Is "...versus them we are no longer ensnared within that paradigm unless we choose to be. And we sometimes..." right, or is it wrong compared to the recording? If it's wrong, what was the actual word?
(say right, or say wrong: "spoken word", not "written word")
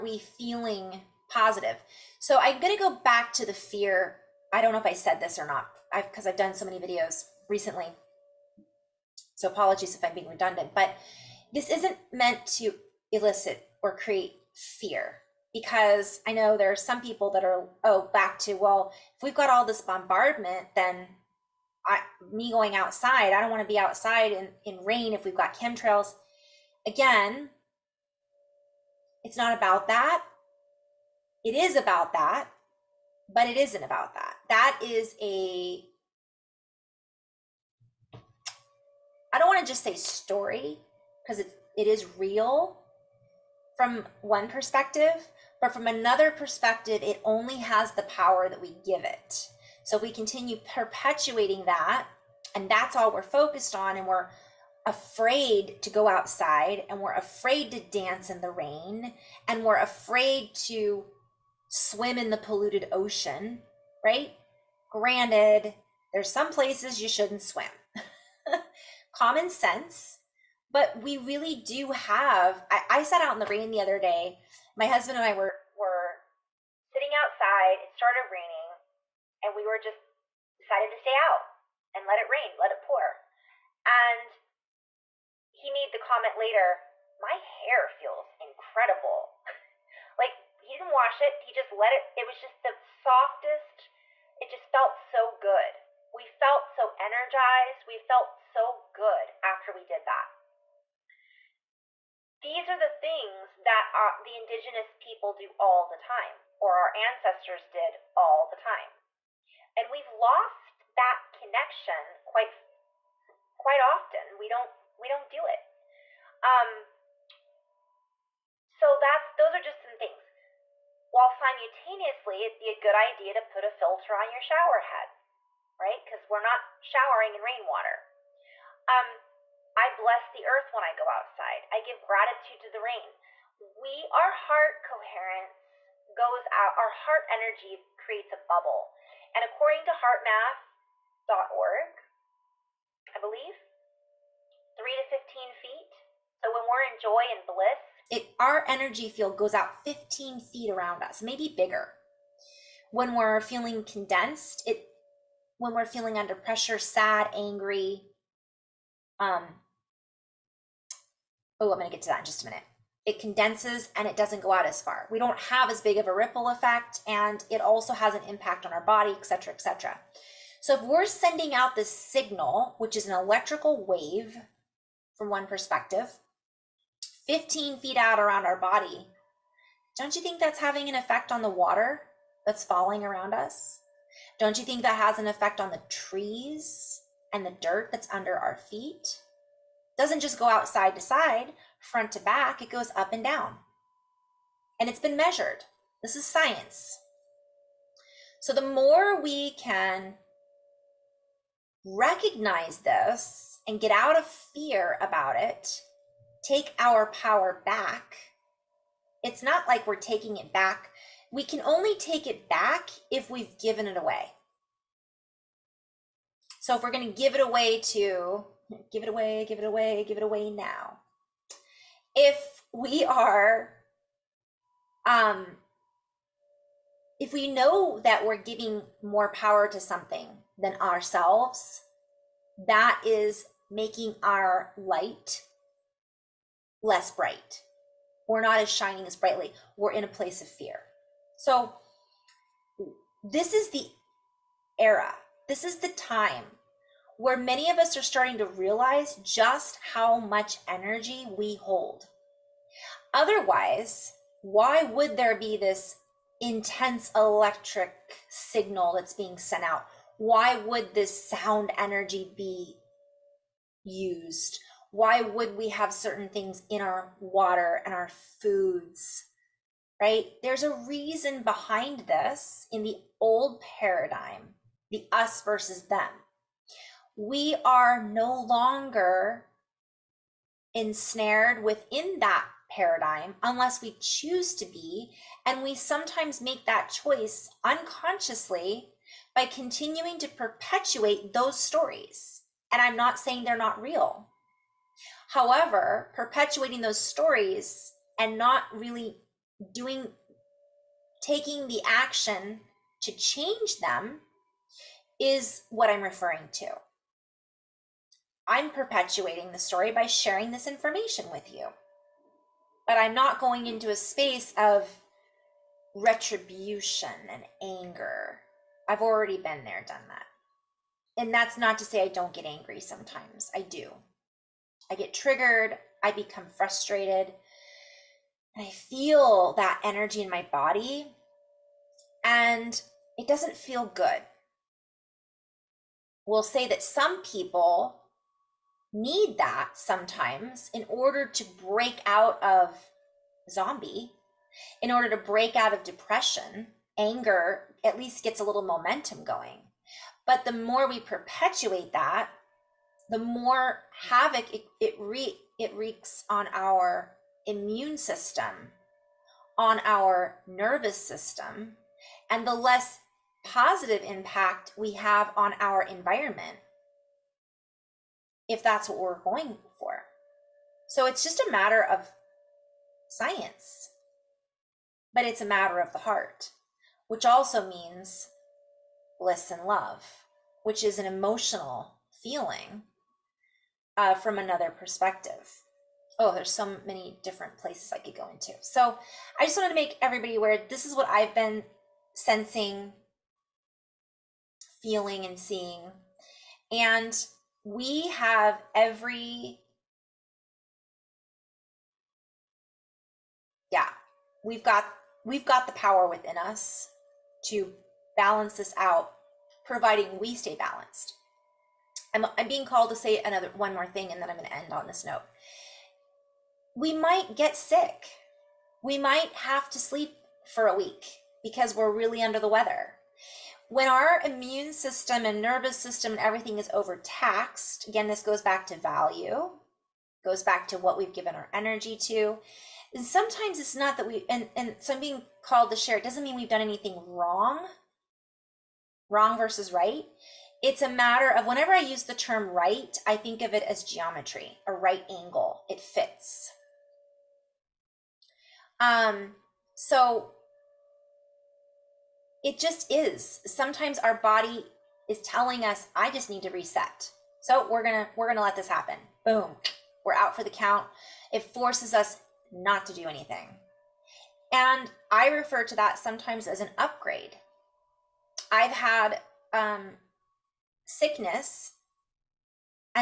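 right.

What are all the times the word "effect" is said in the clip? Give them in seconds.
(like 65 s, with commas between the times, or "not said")
166 s, 180 s, 185 s.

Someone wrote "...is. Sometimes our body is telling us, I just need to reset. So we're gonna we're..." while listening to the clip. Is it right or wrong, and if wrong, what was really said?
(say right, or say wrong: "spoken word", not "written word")
right.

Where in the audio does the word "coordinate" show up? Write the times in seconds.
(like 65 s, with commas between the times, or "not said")
not said.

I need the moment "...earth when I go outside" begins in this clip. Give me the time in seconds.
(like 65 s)
130 s.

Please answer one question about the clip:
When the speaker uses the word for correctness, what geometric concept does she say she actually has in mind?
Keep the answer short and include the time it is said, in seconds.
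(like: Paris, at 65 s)
a right angle, at 444 s.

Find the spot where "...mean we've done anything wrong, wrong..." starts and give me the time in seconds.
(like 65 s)
436 s.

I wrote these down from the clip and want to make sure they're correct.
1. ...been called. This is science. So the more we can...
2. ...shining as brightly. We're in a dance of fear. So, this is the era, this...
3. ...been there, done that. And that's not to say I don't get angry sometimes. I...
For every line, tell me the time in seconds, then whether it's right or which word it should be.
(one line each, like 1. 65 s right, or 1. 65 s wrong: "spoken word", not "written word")
1. 194 s wrong: "measured", not "called"
2. 238 s wrong: "place", not "dance"
3. 319 s right.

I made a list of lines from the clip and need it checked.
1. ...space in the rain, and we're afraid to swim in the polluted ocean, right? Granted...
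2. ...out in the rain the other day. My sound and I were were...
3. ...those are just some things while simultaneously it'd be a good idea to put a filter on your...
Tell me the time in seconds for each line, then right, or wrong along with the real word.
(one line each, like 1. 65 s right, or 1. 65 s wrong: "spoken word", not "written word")
1. 57 s wrong: "dance", not "space"
2. 73 s wrong: "husband", not "sound"
3. 119 s right.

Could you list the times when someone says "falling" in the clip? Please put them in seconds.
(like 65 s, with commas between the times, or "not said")
182 s.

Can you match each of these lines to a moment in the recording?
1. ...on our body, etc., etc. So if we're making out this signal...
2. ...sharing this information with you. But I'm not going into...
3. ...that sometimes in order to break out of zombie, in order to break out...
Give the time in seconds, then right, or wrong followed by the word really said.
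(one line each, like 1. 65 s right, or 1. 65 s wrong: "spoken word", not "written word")
1. 168 s wrong: "sending", not "making"
2. 310 s right
3. 339 s right.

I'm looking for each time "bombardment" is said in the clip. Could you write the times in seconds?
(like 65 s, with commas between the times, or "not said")
19 s.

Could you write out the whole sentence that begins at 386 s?
Oh, there's so many different places I could go into.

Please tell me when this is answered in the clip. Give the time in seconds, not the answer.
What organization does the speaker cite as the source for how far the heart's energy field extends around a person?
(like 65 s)
139 s.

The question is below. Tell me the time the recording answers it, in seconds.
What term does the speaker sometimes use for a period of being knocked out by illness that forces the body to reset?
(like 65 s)
466 s.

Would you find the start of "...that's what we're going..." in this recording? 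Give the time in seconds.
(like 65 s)
368 s.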